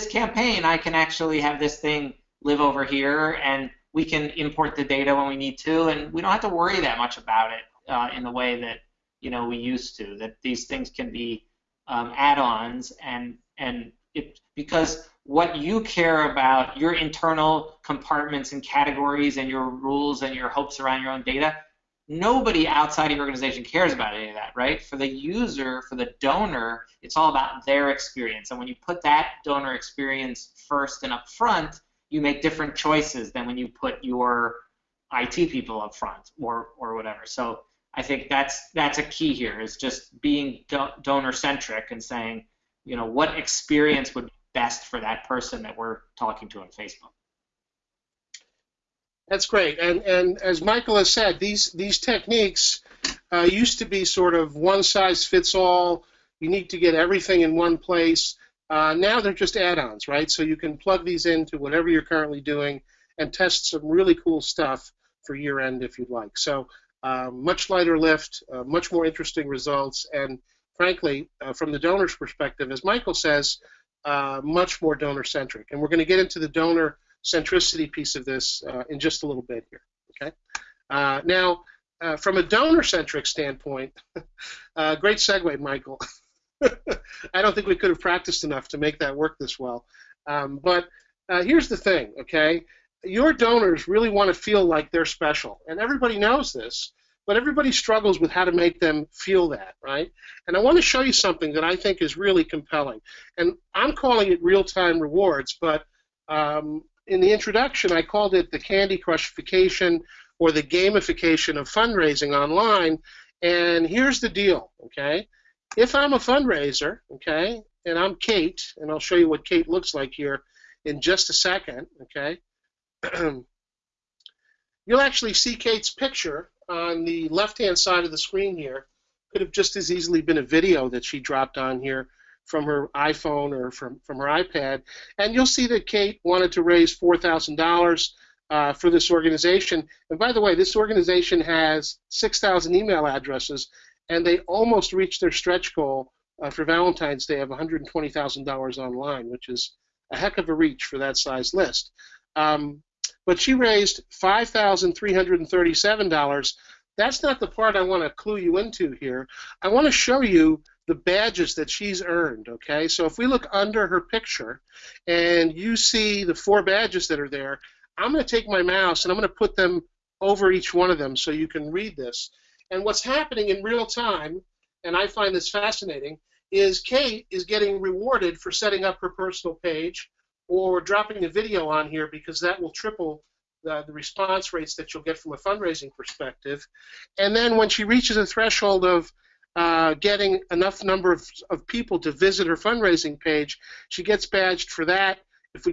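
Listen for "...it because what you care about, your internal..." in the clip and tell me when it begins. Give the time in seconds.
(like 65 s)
14 s.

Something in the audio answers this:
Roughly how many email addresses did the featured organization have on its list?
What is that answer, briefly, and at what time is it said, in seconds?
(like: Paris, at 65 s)
6,000, at 142 s.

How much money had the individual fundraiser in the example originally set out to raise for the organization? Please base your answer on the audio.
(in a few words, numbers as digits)
$4,000.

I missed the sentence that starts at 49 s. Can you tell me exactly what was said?
That's great, and and as Michael has said, these these techniques uh, used to be sort of one size fits all.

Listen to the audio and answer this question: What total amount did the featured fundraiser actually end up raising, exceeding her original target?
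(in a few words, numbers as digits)
$5,337.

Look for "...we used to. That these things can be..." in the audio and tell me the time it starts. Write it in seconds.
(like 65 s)
9 s.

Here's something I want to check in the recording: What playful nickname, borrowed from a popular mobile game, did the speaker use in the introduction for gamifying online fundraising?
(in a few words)
Candy Crushification.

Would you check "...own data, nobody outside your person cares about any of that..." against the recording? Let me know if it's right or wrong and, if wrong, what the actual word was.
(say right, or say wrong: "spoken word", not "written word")
wrong: "organization", not "person".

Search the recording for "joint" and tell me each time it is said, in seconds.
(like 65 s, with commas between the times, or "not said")
not said.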